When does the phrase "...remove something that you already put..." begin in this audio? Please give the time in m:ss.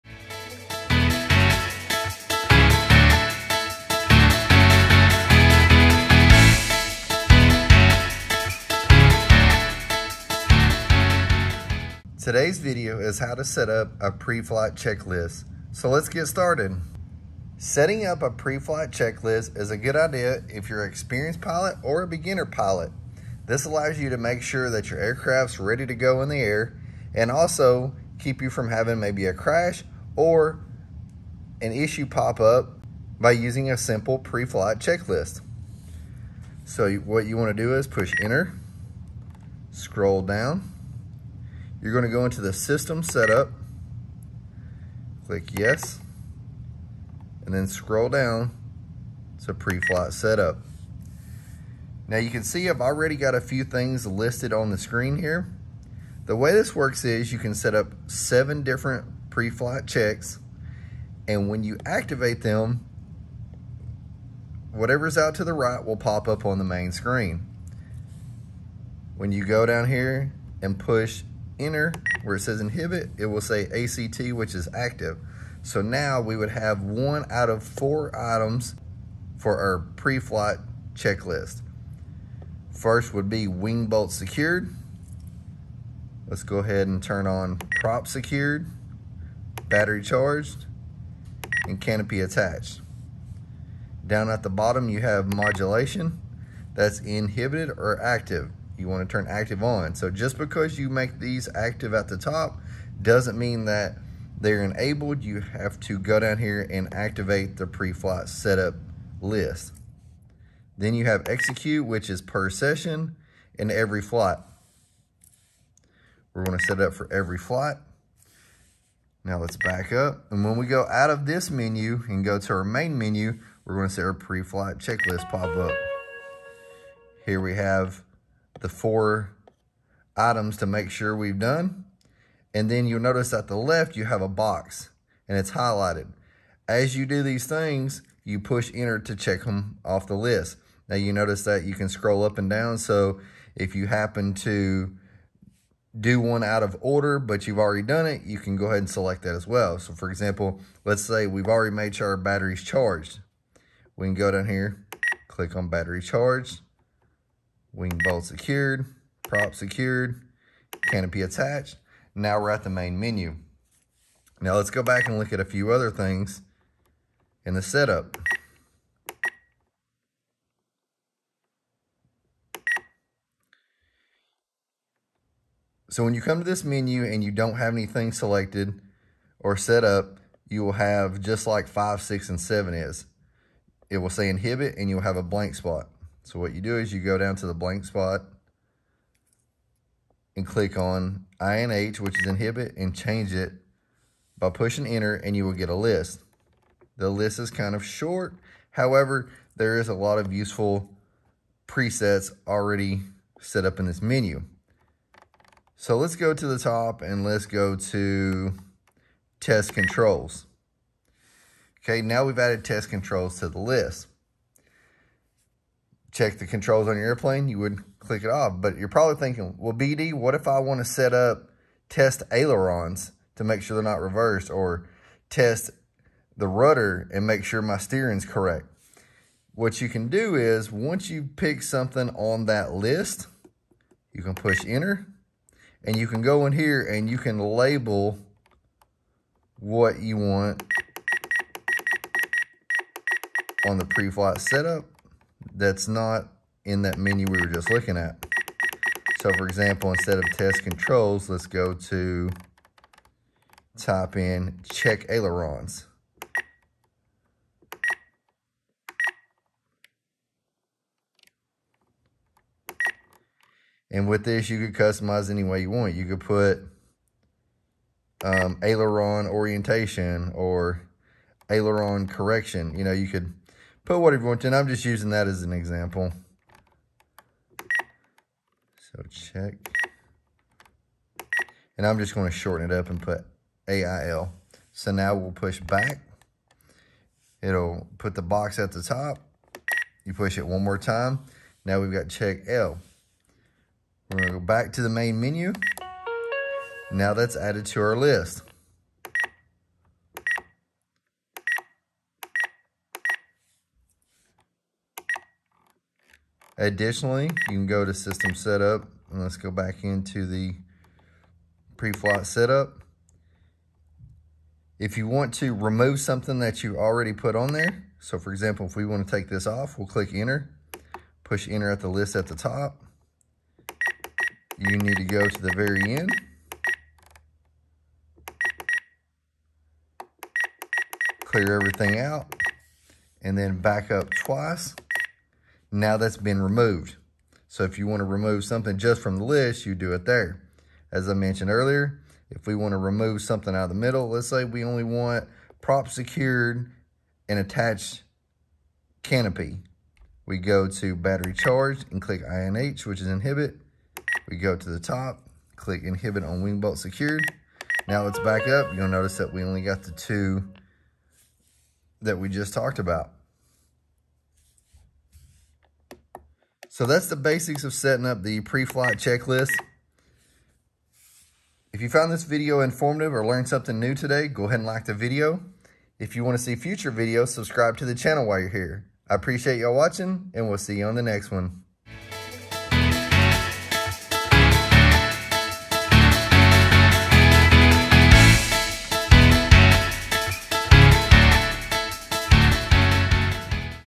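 5:15.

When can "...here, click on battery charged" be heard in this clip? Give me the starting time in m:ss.
2:34.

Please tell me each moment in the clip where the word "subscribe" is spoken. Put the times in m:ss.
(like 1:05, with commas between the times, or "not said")
6:17.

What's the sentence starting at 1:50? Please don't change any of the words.
Then you have execute, which is per session and every flight.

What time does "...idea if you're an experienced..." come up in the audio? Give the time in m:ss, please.
0:19.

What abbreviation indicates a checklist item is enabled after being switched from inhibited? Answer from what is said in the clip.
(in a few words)
ACT.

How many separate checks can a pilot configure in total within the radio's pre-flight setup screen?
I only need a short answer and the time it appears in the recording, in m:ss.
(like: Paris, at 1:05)
7, at 0:58.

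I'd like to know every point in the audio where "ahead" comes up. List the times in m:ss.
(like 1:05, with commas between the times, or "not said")
1:26, 2:28, 6:14.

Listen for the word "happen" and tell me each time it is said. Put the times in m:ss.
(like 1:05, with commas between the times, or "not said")
2:23.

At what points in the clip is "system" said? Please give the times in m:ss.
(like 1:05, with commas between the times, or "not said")
0:42, 5:07.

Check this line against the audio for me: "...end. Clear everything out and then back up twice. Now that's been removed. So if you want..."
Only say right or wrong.
right.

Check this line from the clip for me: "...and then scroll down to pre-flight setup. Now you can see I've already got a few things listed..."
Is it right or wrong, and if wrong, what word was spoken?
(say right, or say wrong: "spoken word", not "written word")
right.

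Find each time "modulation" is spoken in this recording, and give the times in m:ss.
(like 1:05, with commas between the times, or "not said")
1:35.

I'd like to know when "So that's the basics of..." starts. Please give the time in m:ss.
6:06.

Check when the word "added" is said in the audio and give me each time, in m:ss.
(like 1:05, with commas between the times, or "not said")
3:32, 4:57.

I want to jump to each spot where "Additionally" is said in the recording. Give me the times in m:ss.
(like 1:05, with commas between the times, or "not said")
5:06.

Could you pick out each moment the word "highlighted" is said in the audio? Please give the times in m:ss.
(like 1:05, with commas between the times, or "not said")
2:15.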